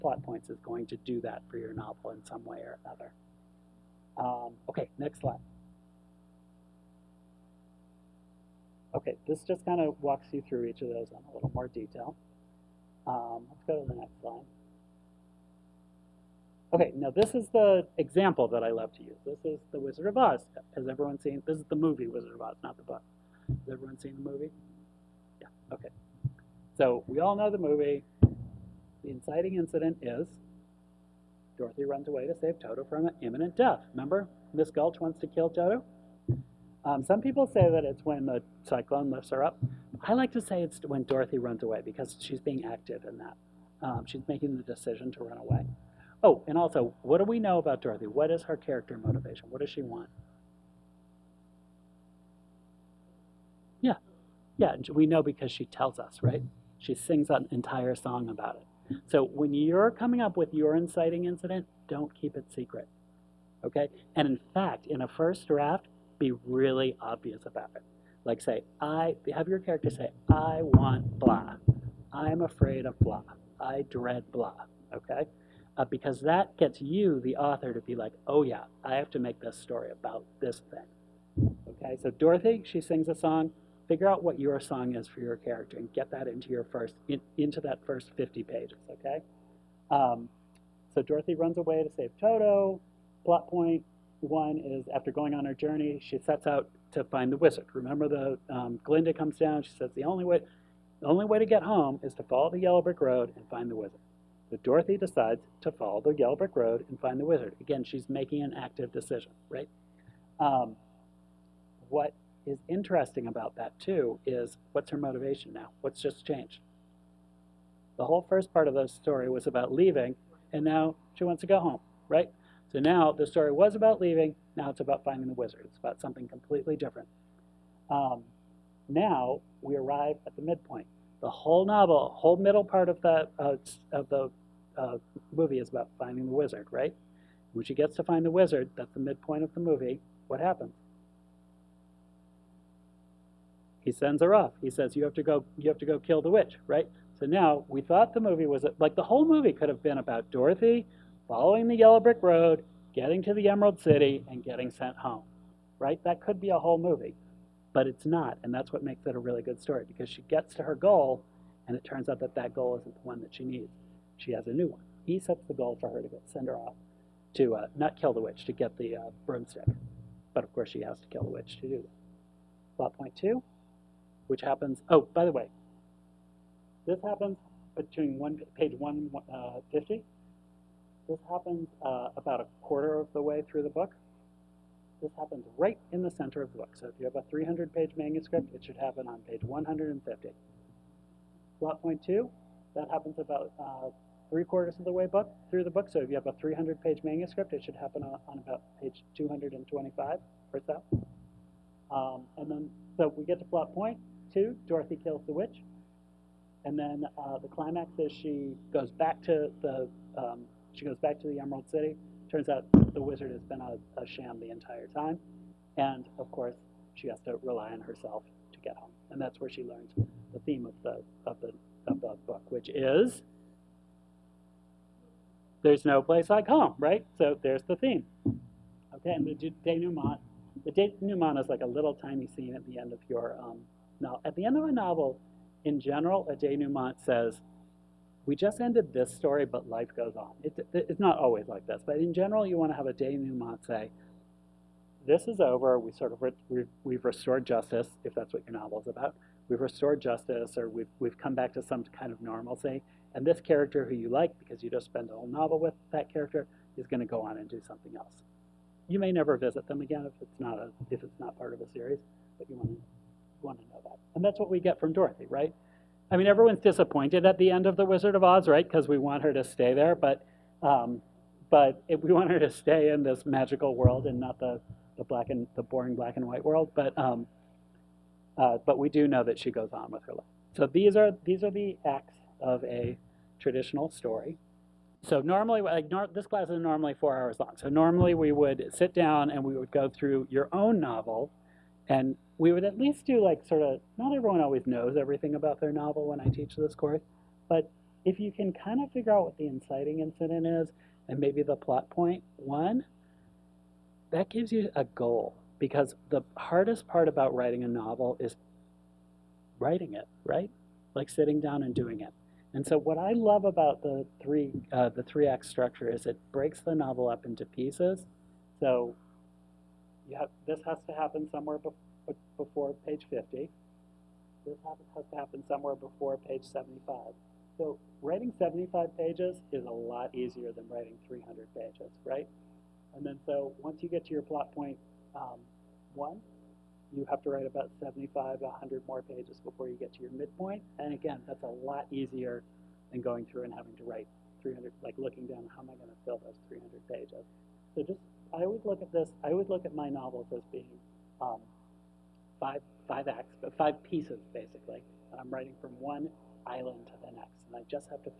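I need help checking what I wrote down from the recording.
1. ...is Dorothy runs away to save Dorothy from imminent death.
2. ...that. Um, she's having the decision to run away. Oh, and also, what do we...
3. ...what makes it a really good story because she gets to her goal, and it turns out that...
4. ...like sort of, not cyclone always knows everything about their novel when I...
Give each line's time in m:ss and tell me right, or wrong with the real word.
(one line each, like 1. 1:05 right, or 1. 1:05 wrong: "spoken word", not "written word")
1. 0:30 wrong: "Toto", not "Dorothy"
2. 0:43 wrong: "making", not "having"
3. 2:38 right
4. 4:53 wrong: "everyone", not "cyclone".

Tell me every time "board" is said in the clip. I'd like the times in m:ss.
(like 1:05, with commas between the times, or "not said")
not said.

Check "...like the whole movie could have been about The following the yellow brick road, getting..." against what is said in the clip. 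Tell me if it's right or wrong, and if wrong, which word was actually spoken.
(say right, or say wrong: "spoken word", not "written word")
wrong: "Dorothy", not "The".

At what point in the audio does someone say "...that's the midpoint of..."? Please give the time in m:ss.
2:18.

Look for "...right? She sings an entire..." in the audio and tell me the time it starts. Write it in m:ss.
0:56.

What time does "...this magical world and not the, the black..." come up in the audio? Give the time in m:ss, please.
4:33.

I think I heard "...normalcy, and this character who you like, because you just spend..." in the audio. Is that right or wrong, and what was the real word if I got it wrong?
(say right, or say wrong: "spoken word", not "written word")
right.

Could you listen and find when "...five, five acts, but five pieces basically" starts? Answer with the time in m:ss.
5:52.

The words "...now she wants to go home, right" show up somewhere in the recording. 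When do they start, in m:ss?
2:00.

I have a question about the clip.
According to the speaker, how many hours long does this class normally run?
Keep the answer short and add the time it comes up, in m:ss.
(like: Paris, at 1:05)
4 hours, at 4:46.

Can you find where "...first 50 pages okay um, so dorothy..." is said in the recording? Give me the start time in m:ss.
1:27.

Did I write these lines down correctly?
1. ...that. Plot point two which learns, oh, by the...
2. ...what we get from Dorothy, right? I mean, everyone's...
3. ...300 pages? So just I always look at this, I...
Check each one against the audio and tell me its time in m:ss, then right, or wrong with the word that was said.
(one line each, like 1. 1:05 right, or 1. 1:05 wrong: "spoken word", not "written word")
1. 2:51 wrong: "happens", not "learns"
2. 4:24 right
3. 5:46 right.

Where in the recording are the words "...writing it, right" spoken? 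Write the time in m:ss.
5:09.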